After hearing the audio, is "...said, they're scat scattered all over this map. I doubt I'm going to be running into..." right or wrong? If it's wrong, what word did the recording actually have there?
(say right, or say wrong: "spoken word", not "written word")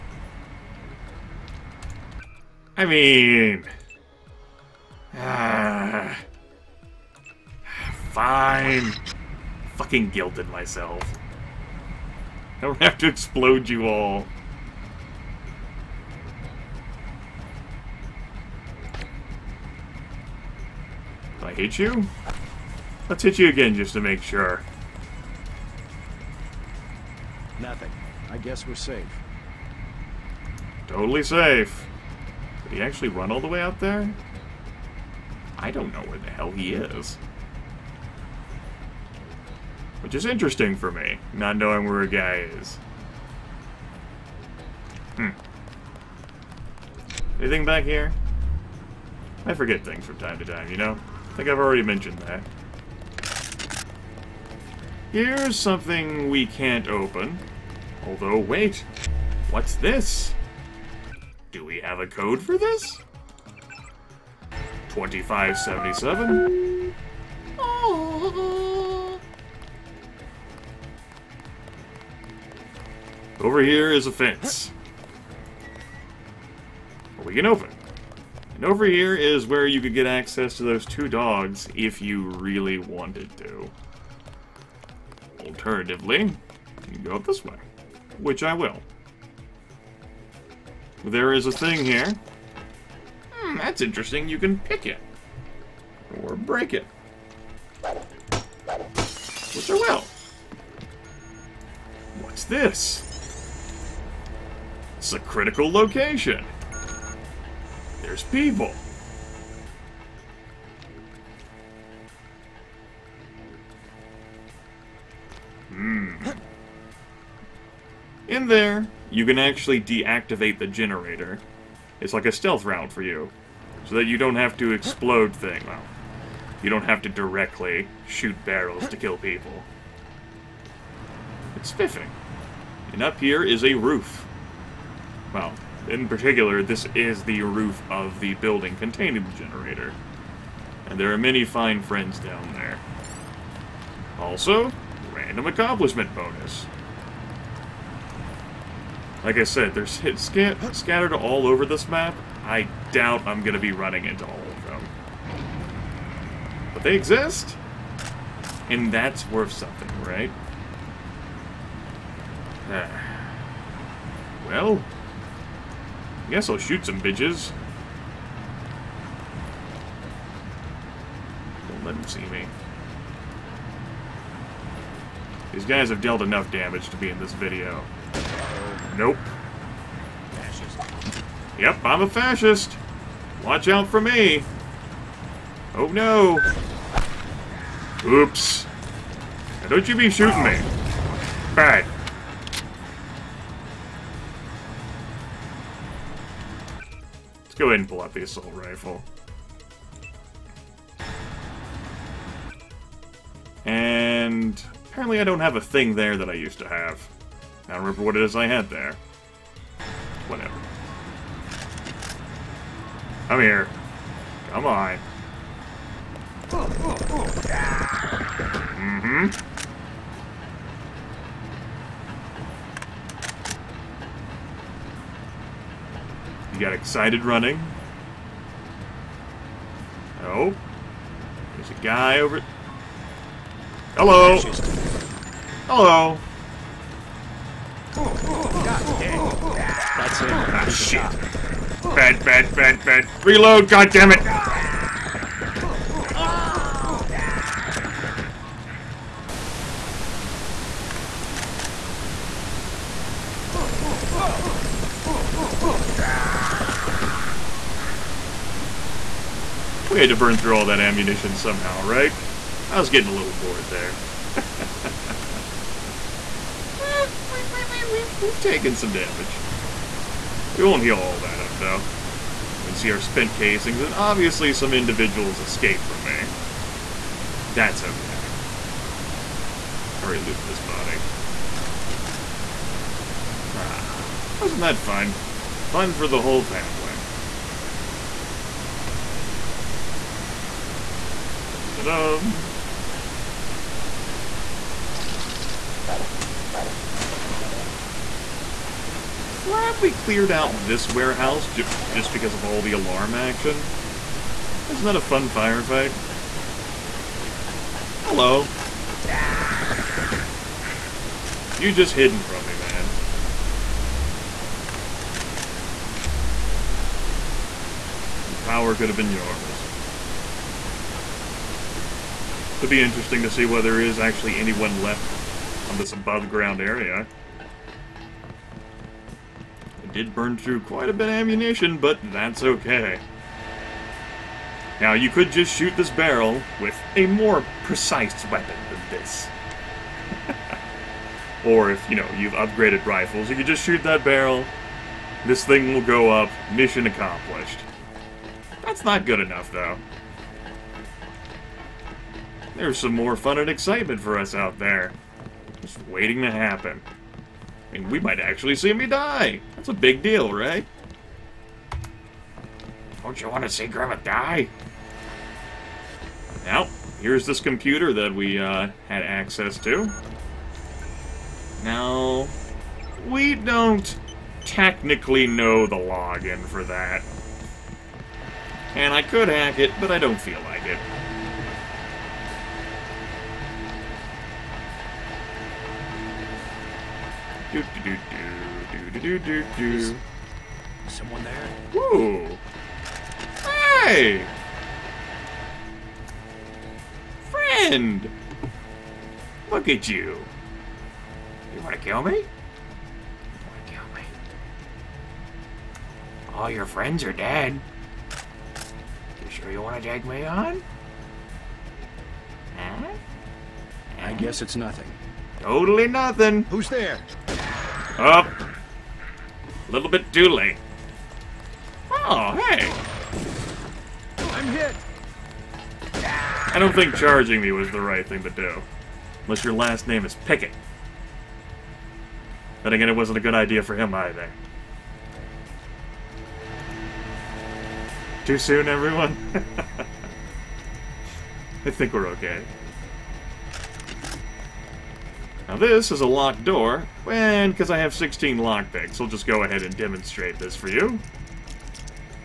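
right.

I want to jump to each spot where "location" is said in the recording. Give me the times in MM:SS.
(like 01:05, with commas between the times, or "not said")
01:45.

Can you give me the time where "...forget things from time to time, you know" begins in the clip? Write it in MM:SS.
00:49.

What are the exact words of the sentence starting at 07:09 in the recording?
Unless your last name is Pickett.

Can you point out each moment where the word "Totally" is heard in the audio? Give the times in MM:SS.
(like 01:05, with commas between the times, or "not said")
00:30, 06:55.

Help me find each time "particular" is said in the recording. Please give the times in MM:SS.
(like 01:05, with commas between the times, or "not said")
02:16.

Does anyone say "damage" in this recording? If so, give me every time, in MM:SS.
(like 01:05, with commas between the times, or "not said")
02:56, 04:28.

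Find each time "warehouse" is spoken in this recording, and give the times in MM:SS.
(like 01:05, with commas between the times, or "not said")
05:00.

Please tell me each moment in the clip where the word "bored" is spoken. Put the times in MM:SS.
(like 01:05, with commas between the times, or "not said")
04:23.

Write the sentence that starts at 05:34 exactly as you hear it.
Now, you could just shoot this barrel with a more precise weapon than this.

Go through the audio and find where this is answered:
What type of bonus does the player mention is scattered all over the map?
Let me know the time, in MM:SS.
02:25.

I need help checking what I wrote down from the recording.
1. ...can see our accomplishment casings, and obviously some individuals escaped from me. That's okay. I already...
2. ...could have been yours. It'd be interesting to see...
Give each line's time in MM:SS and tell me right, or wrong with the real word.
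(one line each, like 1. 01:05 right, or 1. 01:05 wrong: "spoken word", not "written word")
1. 04:32 wrong: "spent", not "accomplishment"
2. 05:18 right.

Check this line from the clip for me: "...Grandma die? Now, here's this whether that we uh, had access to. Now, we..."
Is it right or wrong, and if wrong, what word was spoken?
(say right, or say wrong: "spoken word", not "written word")
wrong: "computer", not "whether".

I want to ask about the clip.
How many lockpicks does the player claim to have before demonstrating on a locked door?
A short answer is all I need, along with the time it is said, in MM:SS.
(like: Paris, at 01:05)
16, at 07:27.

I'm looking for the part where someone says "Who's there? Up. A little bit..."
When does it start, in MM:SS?
06:56.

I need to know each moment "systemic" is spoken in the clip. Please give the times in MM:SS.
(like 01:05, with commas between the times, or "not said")
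not said.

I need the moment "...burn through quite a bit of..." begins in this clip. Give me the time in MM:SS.
05:30.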